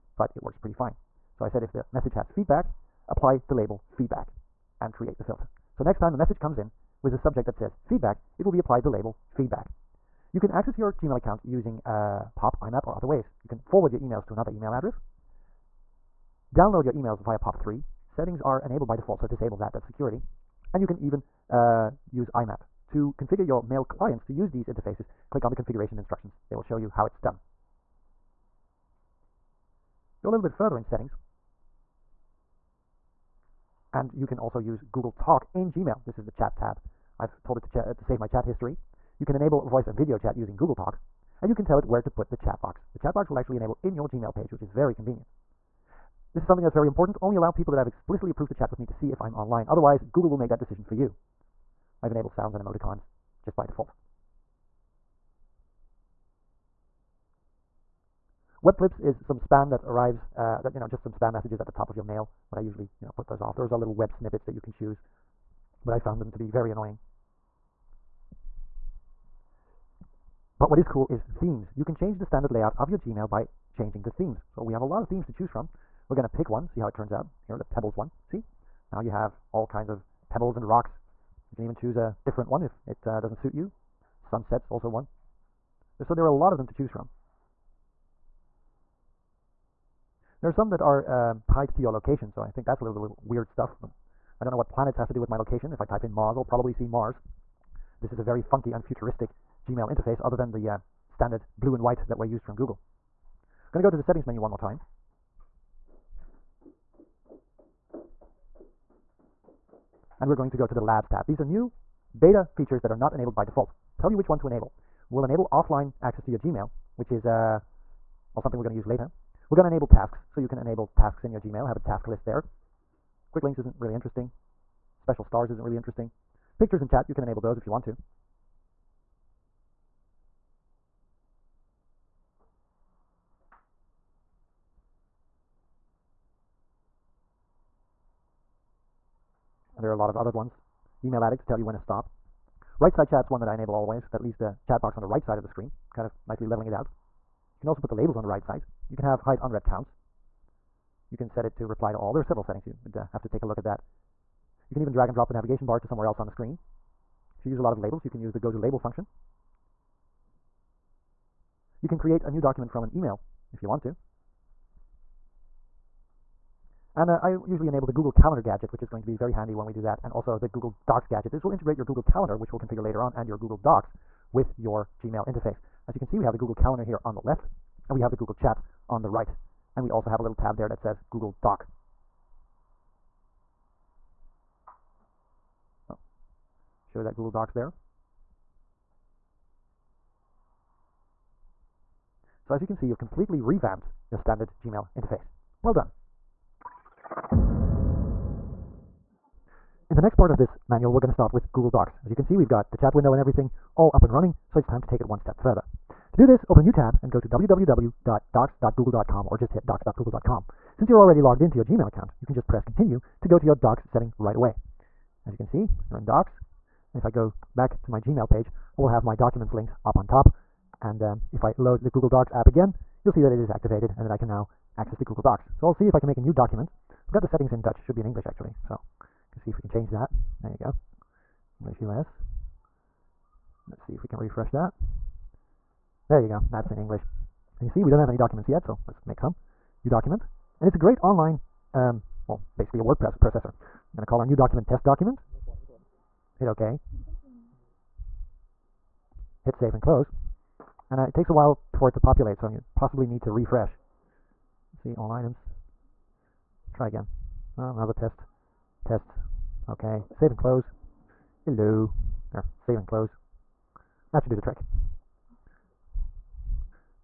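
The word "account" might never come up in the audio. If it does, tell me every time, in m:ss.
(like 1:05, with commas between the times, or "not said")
0:11, 3:31.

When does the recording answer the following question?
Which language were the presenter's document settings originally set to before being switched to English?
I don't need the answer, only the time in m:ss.
3:47.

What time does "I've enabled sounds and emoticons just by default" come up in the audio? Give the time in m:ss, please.
0:52.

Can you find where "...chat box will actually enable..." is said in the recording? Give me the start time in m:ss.
0:42.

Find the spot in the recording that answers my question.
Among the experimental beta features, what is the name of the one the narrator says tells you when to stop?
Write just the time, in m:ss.
2:21.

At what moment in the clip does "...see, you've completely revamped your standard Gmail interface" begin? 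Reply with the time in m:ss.
3:12.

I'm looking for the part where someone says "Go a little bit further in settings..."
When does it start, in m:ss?
0:30.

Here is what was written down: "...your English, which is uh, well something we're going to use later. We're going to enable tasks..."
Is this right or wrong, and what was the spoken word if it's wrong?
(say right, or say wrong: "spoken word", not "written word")
wrong: "Gmail", not "English".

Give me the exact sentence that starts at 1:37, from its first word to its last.
This is a very funky and futuristic Gmail interface, other than the uh, standard blue and white that were used from Google.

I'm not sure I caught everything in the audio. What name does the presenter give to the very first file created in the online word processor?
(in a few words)
test document.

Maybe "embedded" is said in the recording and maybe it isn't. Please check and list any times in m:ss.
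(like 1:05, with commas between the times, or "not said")
not said.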